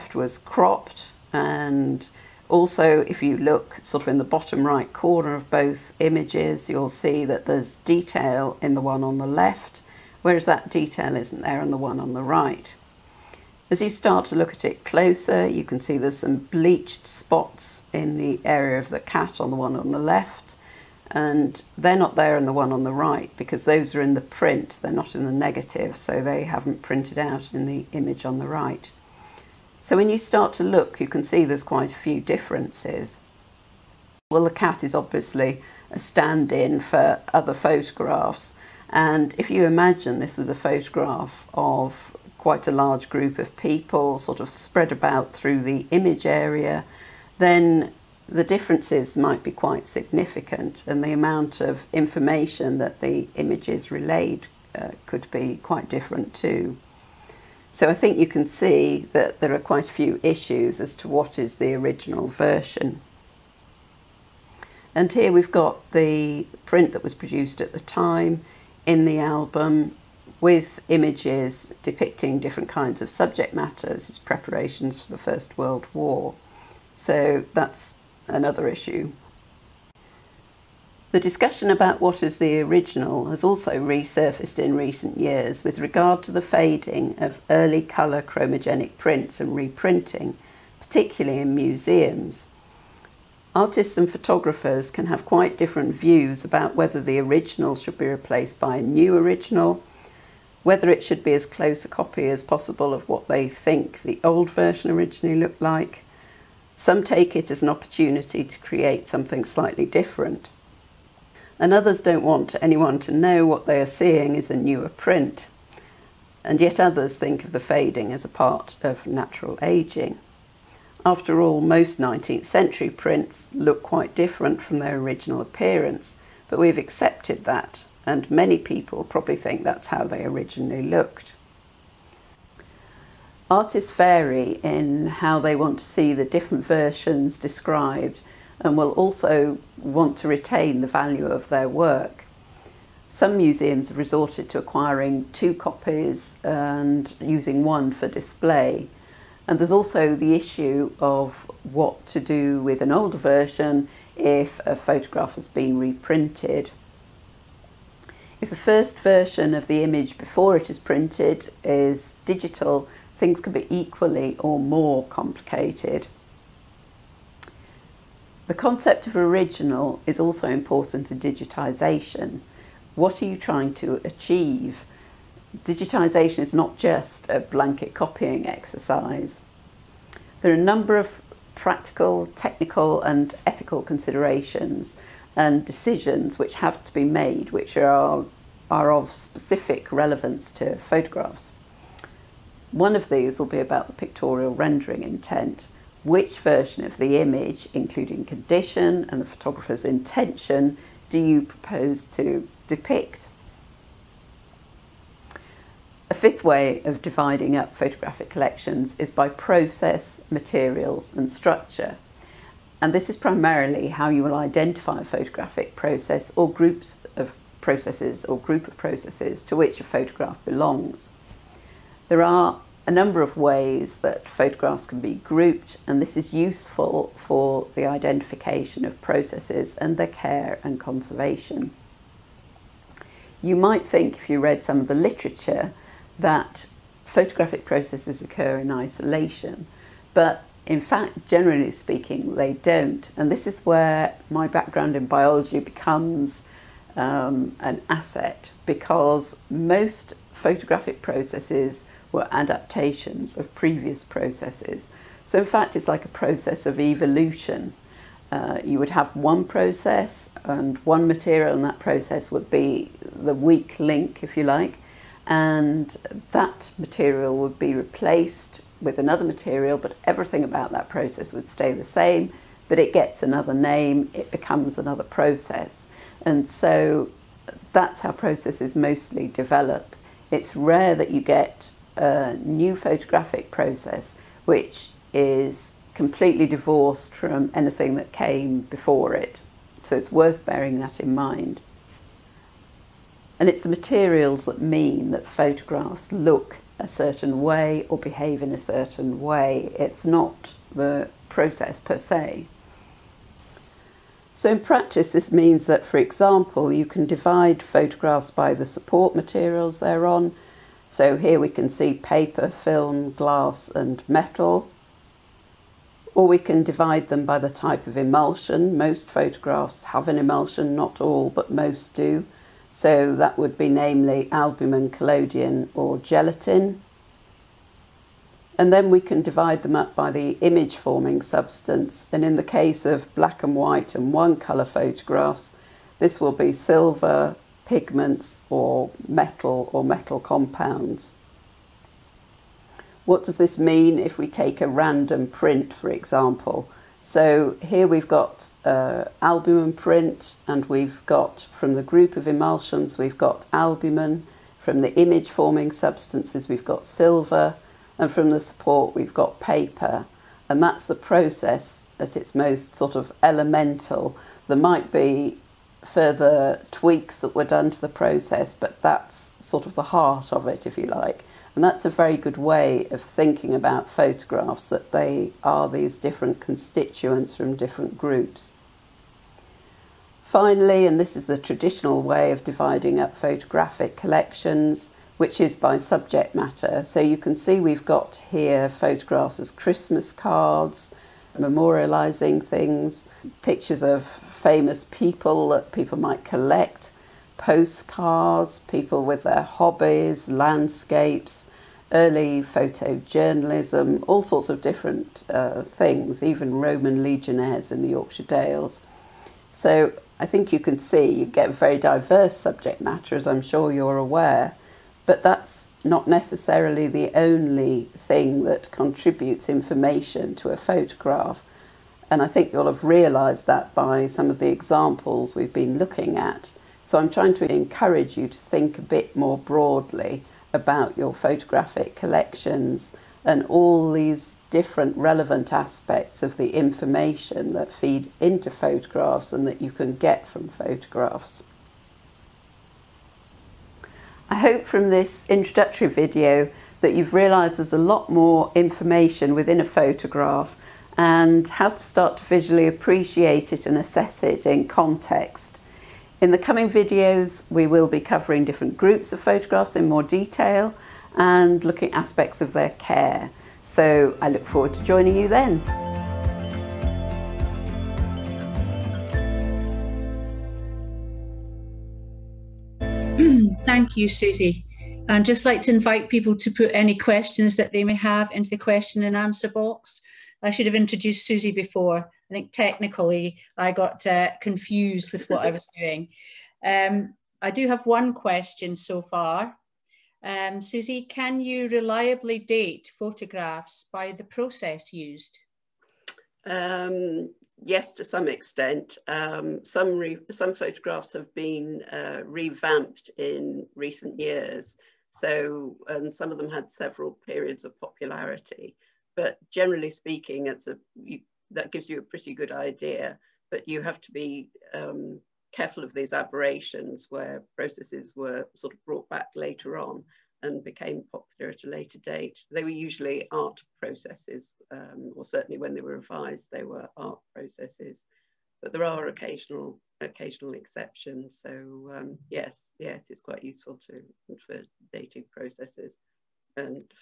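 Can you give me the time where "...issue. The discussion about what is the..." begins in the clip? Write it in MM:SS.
01:18.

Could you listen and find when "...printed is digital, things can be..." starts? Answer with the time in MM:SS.
02:40.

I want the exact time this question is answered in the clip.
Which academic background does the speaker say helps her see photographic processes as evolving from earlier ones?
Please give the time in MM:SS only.
04:05.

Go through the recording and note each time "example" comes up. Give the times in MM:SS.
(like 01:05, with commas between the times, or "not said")
05:05, 05:45, 07:04.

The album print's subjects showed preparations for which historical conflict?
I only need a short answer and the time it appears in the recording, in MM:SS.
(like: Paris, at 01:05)
First World War, at 01:15.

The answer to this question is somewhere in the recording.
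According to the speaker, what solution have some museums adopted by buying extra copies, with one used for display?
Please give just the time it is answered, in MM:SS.
02:24.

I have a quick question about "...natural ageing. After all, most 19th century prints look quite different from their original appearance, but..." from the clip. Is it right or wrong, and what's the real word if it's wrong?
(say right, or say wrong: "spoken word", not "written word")
right.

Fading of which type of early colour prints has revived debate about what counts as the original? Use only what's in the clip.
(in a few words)
Chromogenic prints.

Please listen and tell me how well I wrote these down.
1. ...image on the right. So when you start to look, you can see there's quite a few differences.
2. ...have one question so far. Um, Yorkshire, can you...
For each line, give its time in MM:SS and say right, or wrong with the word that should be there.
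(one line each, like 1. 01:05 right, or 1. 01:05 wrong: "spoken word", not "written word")
1. 00:27 right
2. 08:07 wrong: "Susie", not "Yorkshire".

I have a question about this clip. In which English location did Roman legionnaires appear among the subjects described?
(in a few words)
Yorkshire Dales.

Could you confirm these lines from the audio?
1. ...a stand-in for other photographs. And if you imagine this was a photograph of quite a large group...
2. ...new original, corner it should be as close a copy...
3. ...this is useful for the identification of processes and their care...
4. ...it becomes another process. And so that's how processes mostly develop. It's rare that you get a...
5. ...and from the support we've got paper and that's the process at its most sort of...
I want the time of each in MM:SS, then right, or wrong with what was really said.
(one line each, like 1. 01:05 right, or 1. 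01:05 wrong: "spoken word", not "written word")
1. 00:35 right
2. 01:38 wrong: "whether", not "corner"
3. 03:46 right
4. 04:34 right
5. 05:57 right.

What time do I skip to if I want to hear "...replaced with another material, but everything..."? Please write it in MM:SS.
04:27.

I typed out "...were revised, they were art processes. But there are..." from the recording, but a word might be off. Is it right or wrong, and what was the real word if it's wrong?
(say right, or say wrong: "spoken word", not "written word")
right.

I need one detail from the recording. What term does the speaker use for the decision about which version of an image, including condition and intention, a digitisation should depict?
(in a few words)
Pictorial rendering intent.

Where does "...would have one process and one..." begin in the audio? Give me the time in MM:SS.
04:18.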